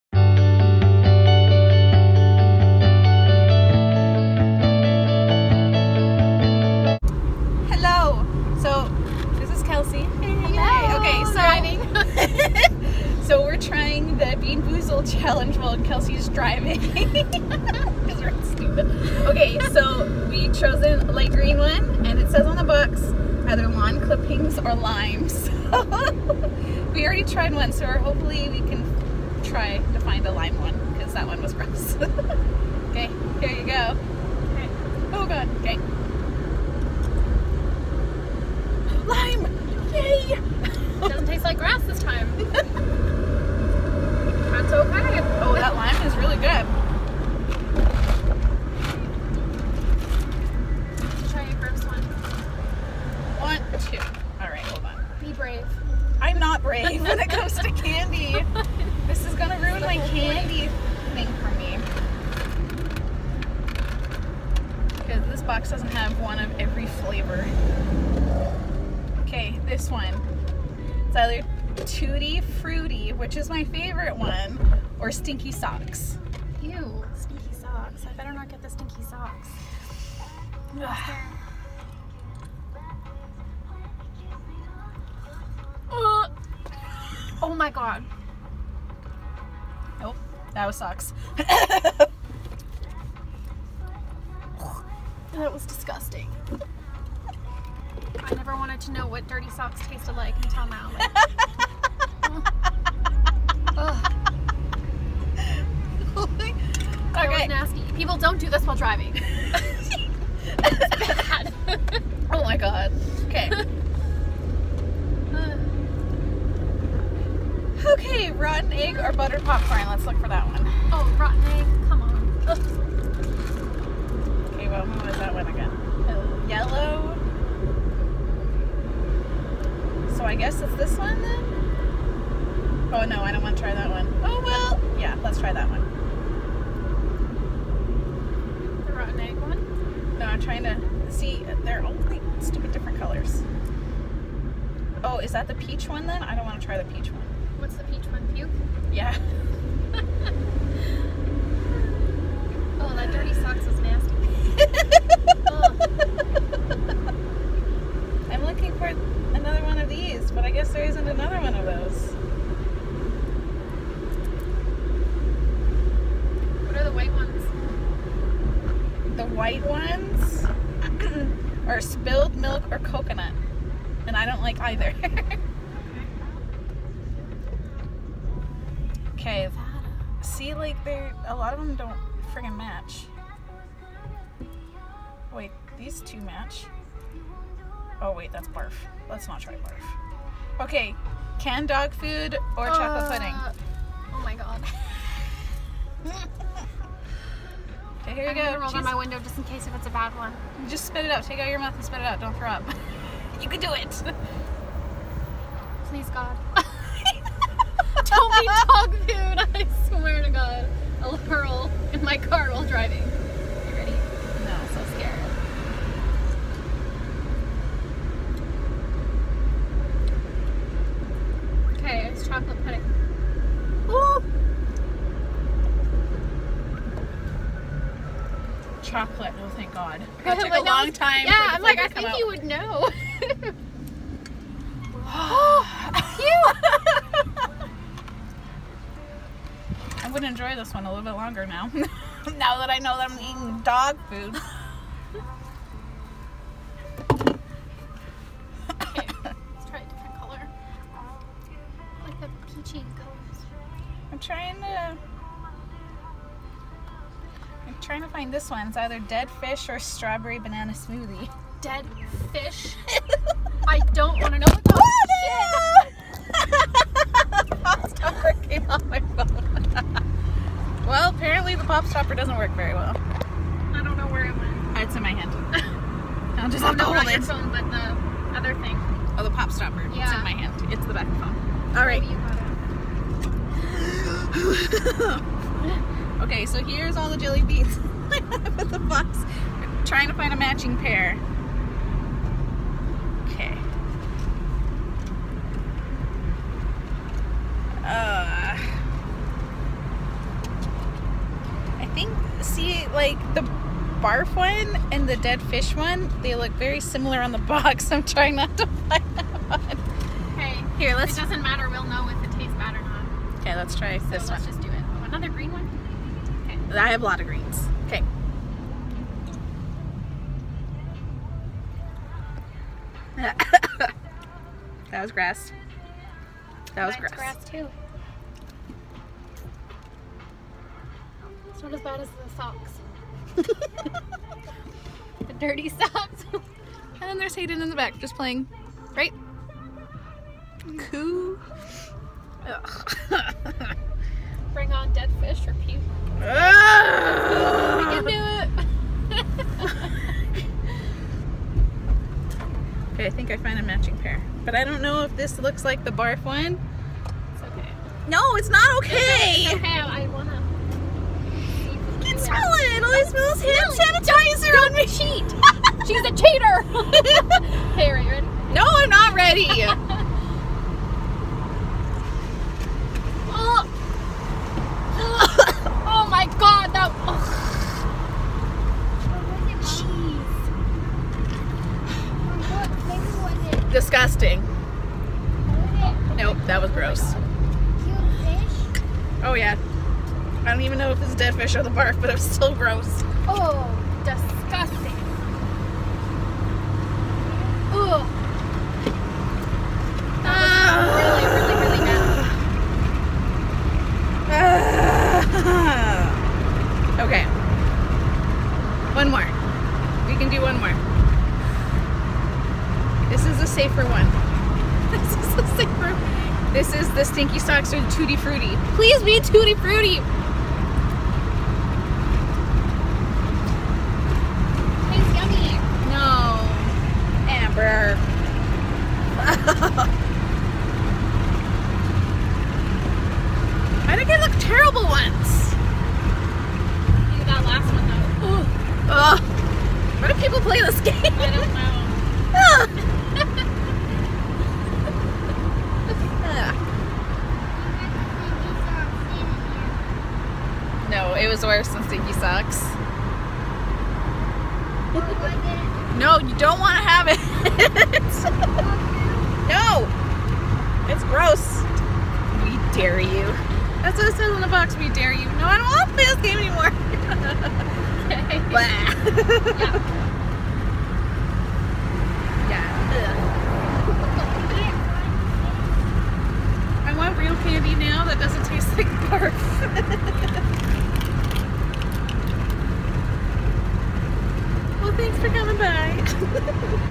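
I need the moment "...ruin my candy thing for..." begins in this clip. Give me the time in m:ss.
0:59.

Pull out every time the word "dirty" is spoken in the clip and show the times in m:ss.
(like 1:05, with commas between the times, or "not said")
1:39, 5:35.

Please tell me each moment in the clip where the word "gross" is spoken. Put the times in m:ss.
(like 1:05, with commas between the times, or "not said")
0:31, 6:26, 6:32, 7:41.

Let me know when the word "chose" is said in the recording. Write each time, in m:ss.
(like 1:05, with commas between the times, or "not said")
0:20.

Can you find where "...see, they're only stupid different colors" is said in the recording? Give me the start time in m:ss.
2:21.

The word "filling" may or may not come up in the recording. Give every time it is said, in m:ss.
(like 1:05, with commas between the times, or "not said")
not said.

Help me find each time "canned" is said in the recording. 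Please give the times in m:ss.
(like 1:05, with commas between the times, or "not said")
3:11.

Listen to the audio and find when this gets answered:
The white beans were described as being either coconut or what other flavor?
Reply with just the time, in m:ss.
2:51.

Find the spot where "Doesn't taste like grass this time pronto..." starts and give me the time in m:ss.
0:41.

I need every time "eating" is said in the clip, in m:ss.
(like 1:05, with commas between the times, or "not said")
4:03.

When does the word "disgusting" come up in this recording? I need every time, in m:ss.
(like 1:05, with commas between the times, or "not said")
1:35, 6:23.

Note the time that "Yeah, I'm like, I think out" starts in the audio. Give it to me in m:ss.
3:51.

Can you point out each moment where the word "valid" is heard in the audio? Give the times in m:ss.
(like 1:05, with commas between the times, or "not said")
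not said.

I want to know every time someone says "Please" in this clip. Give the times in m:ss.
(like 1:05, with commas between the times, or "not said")
3:25, 6:58.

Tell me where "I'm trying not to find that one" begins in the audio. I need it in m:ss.
5:07.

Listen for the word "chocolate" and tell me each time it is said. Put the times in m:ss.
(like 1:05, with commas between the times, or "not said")
3:12, 3:48.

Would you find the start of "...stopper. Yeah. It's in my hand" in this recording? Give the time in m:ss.
4:39.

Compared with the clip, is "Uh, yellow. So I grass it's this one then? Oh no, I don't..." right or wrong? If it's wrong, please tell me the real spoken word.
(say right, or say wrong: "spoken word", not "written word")
wrong: "guess", not "grass".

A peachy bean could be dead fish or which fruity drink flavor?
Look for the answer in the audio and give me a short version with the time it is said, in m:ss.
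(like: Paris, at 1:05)
Strawberry banana smoothie, at 4:19.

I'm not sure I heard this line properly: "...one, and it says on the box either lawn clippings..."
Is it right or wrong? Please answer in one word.
right.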